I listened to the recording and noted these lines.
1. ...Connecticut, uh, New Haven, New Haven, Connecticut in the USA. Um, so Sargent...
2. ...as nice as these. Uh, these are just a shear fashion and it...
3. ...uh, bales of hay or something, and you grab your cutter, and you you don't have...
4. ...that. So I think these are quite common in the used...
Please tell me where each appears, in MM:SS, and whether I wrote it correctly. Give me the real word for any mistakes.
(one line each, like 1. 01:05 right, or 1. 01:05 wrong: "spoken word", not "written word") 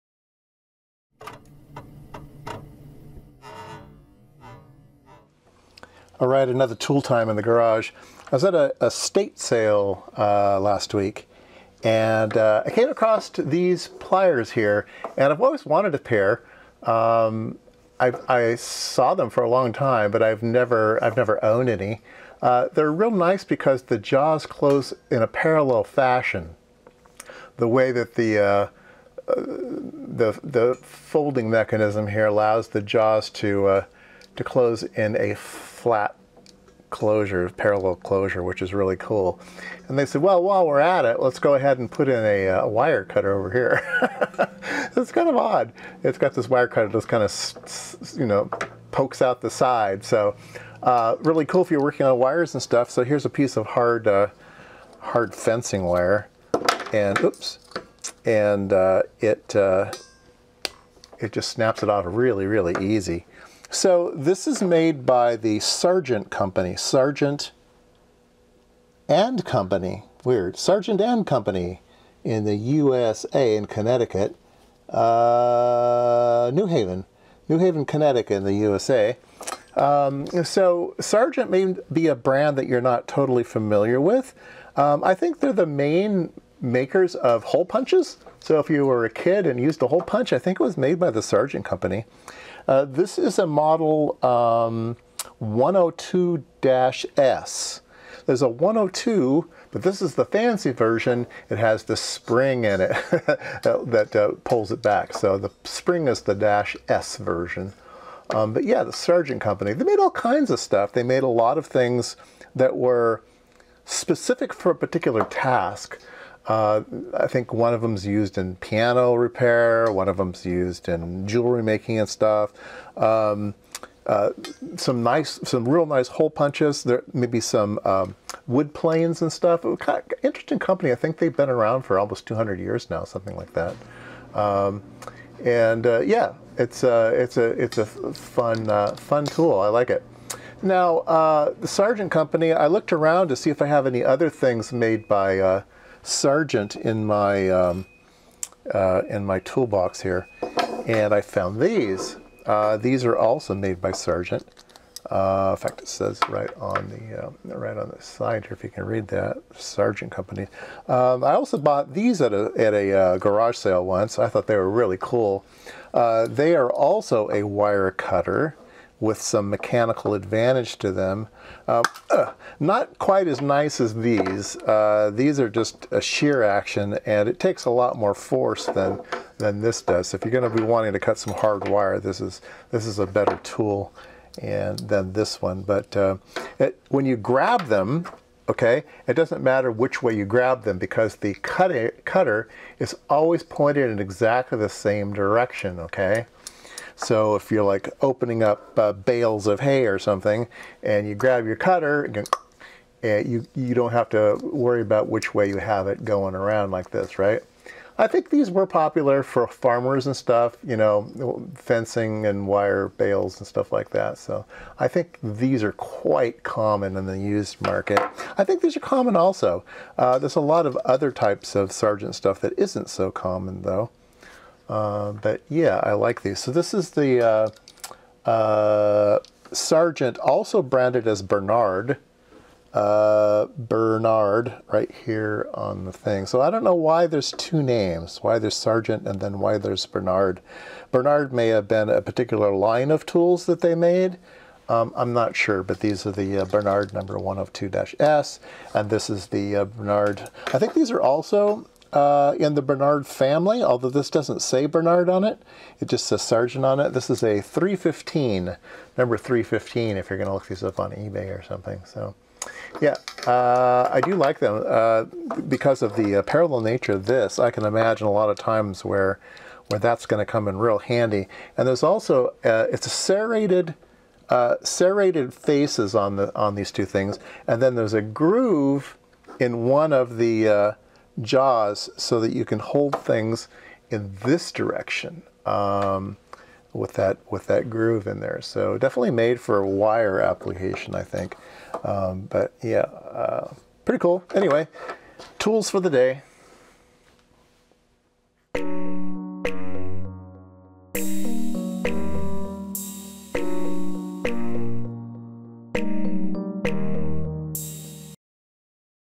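1. 01:13 right
2. 02:53 wrong: "action", not "fashion"
3. 03:18 right
4. 03:33 right.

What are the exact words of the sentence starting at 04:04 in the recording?
Um, I'm not sure, but these are the uh, Bernard number 102-S, and this is the uh, Bernard.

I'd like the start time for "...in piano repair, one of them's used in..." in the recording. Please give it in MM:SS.
01:58.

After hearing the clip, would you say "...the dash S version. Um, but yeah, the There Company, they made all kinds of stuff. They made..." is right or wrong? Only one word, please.
wrong.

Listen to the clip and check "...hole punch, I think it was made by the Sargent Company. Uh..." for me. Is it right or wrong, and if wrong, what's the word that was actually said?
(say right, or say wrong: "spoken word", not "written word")
right.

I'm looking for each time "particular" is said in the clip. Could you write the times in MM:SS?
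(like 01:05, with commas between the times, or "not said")
01:54, 04:02.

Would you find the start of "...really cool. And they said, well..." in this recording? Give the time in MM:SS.
00:38.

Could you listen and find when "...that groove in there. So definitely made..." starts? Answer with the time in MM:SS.
04:47.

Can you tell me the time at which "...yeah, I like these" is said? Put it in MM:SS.
03:45.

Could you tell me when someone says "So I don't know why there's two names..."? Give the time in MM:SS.
03:56.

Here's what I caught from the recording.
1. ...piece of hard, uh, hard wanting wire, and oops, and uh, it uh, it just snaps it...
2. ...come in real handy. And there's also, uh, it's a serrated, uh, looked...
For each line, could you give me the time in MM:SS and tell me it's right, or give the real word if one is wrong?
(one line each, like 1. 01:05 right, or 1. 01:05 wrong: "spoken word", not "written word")
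1. 00:53 wrong: "fencing", not "wanting"
2. 04:30 wrong: "serrated", not "looked".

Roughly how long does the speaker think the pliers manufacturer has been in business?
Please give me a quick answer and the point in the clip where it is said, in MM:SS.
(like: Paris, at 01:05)
almost 200 years, at 02:11.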